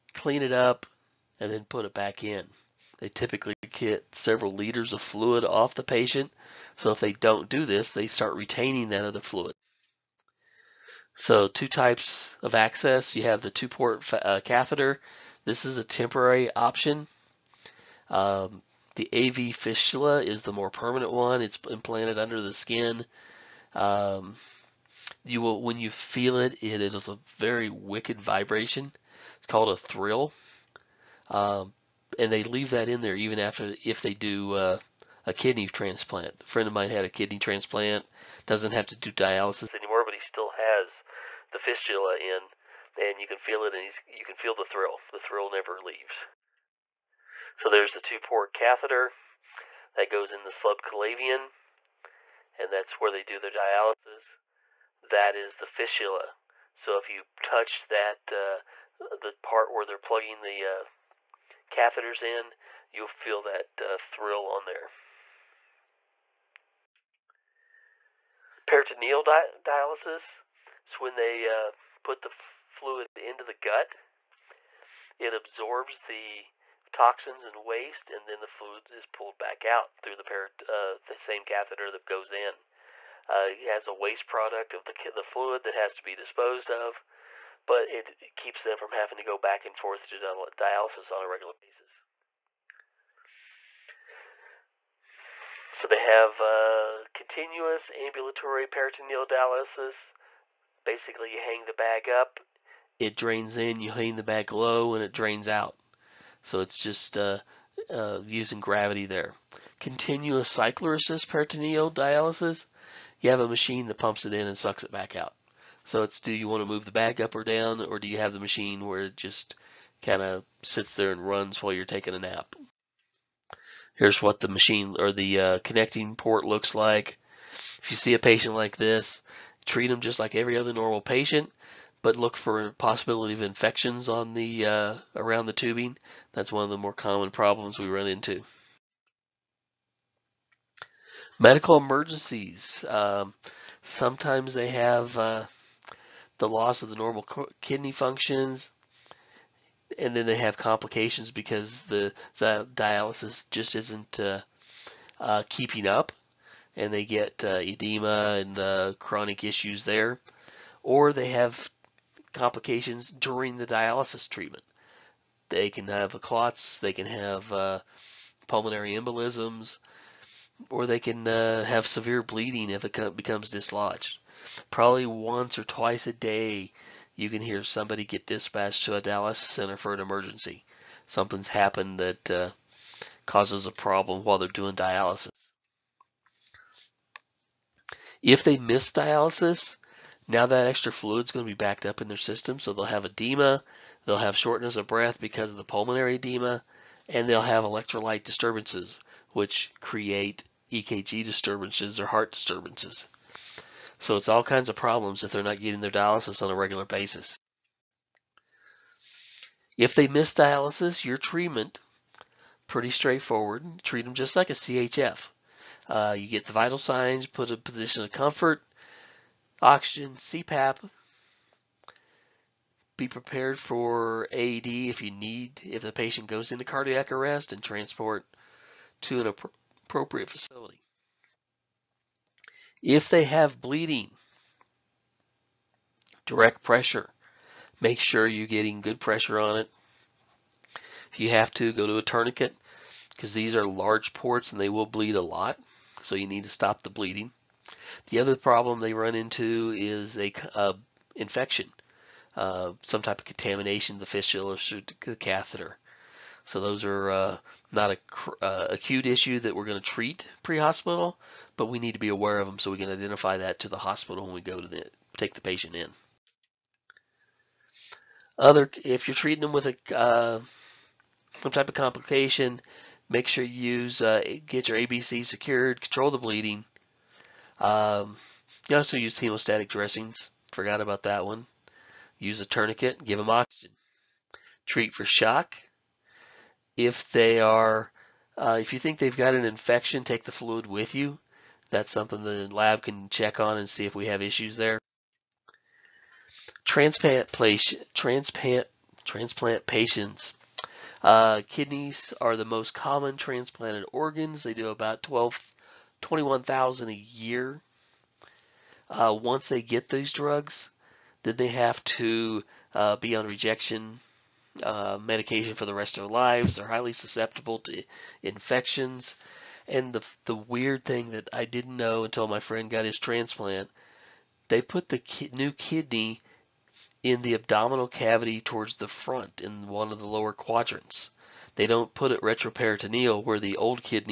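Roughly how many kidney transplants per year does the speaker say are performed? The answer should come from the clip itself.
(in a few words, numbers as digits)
21,000.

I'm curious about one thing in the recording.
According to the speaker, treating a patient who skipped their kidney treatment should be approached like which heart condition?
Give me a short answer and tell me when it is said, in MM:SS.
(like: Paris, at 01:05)
CHF, at 03:33.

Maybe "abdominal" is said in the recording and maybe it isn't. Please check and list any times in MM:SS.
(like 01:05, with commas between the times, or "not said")
05:27.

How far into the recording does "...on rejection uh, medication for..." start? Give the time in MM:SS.
05:13.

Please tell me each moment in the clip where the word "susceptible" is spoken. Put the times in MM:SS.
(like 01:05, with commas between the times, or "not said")
05:16.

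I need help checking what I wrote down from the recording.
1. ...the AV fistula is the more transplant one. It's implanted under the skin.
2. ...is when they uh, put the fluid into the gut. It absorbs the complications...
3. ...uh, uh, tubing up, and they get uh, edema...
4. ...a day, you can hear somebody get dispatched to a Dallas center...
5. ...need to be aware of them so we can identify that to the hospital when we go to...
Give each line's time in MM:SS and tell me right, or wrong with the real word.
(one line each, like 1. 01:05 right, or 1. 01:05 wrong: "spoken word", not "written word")
1. 00:18 wrong: "permanent", not "transplant"
2. 01:10 wrong: "toxins", not "complications"
3. 02:34 wrong: "keeping", not "tubing"
4. 02:56 right
5. 04:21 right.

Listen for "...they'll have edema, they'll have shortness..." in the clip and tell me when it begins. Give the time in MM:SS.
03:12.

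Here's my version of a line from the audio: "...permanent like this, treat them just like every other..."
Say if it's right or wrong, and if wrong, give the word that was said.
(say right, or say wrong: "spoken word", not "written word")
wrong: "patient", not "permanent".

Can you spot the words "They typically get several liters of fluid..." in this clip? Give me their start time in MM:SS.
00:02.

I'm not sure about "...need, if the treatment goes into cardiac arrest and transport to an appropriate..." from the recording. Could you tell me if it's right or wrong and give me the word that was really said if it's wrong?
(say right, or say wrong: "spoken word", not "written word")
wrong: "patient", not "treatment".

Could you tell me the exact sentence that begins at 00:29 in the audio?
It's called a thrill, um, and they leave that in there even after if they do uh, a kidney transplant.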